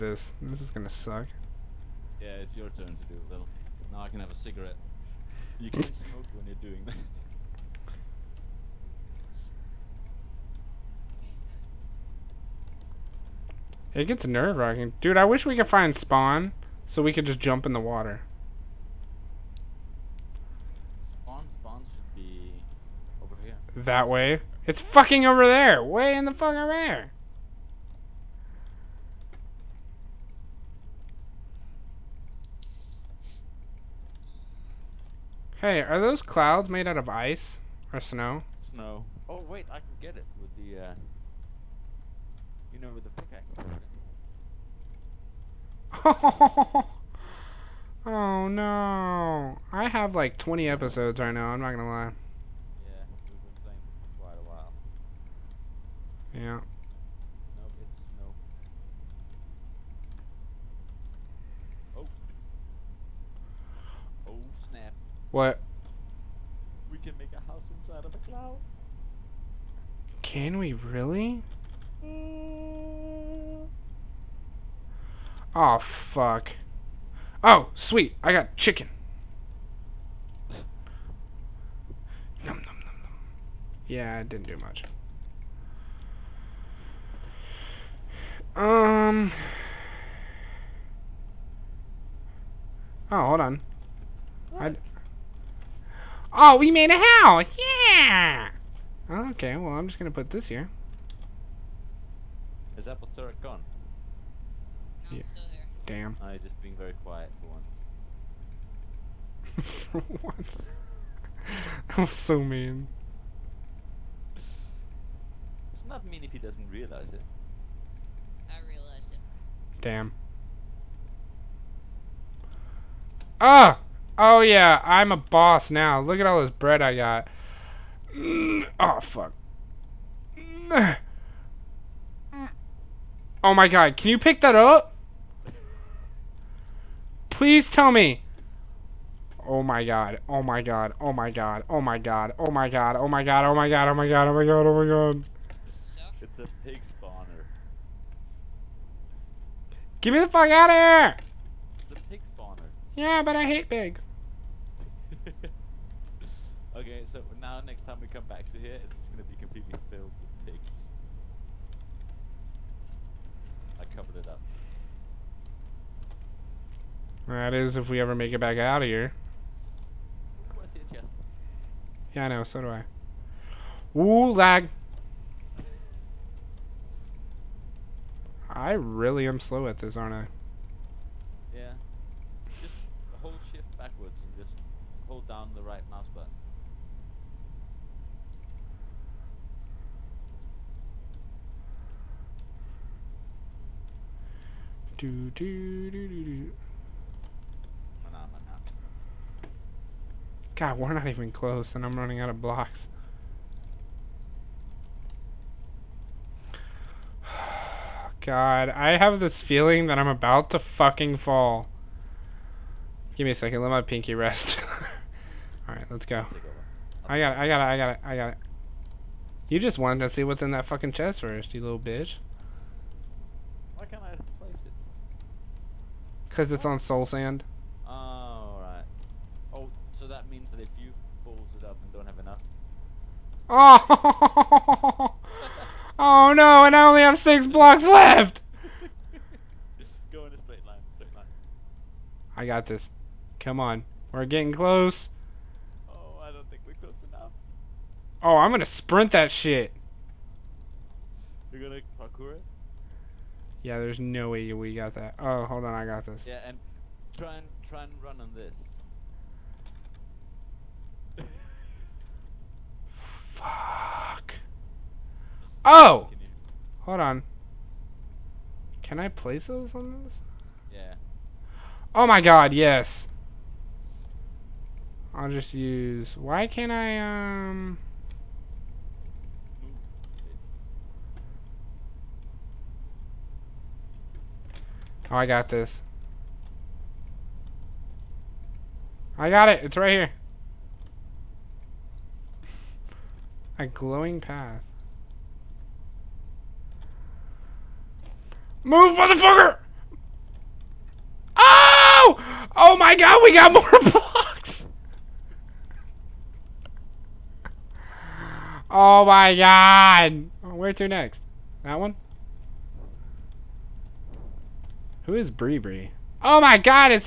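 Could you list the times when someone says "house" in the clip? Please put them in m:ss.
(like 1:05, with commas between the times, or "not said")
1:07, 1:36.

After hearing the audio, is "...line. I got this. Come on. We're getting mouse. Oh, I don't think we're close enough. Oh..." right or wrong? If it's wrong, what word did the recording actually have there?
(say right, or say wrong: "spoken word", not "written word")
wrong: "close", not "mouse".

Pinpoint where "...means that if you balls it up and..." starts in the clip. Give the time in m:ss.
3:50.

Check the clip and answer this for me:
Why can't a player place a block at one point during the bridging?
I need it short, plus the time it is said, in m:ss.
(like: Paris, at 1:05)
Soul sand, at 3:46.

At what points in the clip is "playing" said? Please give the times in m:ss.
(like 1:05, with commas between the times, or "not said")
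0:53.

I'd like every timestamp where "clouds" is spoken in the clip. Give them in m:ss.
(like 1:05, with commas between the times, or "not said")
0:36, 1:08.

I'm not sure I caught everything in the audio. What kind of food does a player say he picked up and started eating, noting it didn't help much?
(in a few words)
Chicken.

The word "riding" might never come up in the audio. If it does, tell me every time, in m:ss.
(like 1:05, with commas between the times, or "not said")
not said.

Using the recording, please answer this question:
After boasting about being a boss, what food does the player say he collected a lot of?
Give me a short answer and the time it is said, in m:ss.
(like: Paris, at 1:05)
Bread, at 2:06.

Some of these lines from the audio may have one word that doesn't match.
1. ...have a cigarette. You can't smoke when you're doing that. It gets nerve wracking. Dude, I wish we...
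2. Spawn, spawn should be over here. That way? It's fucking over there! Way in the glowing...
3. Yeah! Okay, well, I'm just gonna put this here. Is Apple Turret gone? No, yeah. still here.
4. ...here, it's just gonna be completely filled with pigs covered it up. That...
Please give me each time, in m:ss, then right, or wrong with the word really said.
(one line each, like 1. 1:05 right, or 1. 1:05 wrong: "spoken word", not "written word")
1. 0:04 right
2. 0:21 wrong: "fucking", not "glowing"
3. 1:37 right
4. 2:38 right.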